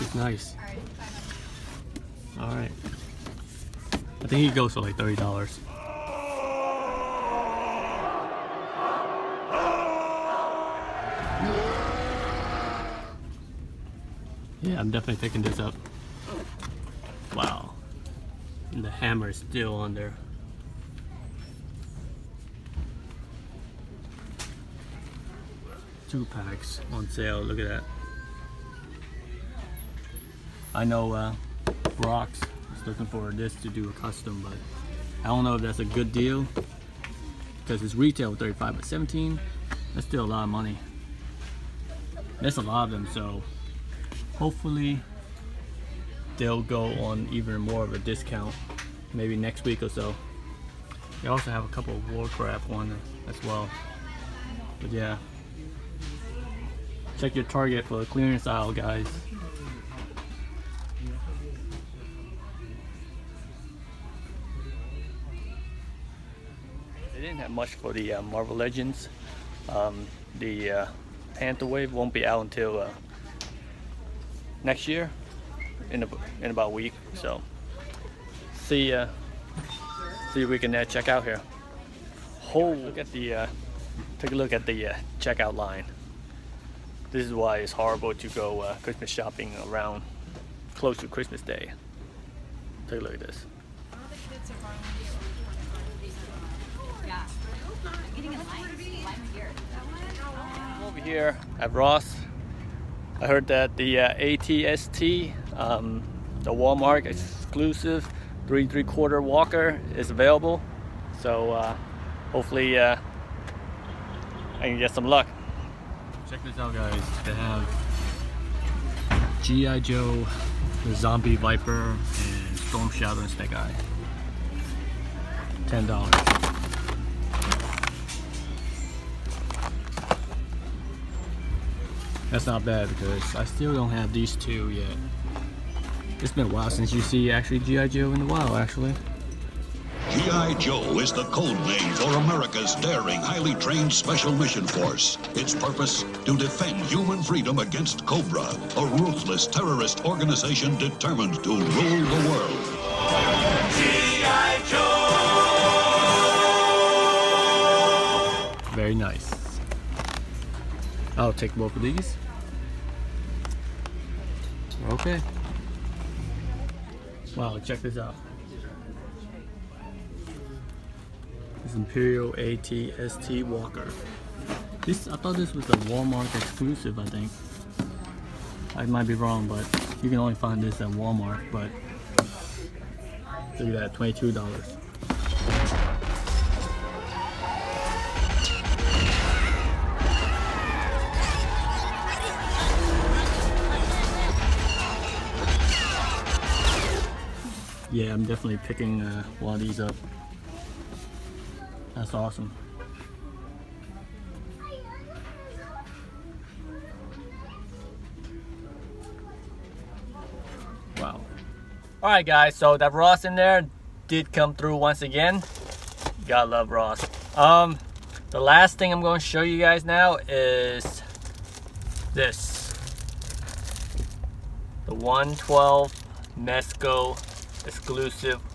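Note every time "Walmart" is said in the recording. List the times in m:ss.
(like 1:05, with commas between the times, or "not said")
1:46, 2:55, 3:00.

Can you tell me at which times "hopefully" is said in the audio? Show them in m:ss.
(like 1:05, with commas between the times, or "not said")
0:44, 1:52.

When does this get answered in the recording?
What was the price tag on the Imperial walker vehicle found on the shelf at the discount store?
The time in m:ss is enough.
3:03.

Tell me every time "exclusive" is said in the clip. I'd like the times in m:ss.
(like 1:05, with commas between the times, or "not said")
1:47, 2:56, 3:47.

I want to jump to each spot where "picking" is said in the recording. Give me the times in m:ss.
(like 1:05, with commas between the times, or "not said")
0:15, 3:18.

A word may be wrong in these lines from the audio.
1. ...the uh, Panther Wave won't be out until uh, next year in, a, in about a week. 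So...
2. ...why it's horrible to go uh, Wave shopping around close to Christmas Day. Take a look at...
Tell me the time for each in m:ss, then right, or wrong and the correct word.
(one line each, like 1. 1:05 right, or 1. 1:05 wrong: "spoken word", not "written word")
1. 1:10 right
2. 1:27 wrong: "Christmas", not "Wave".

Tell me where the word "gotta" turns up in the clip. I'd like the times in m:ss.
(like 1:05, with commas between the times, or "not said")
3:36.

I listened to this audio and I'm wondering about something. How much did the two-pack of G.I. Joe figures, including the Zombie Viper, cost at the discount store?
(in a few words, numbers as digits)
$10.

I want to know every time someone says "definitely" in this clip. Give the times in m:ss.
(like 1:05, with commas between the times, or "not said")
0:14, 3:18.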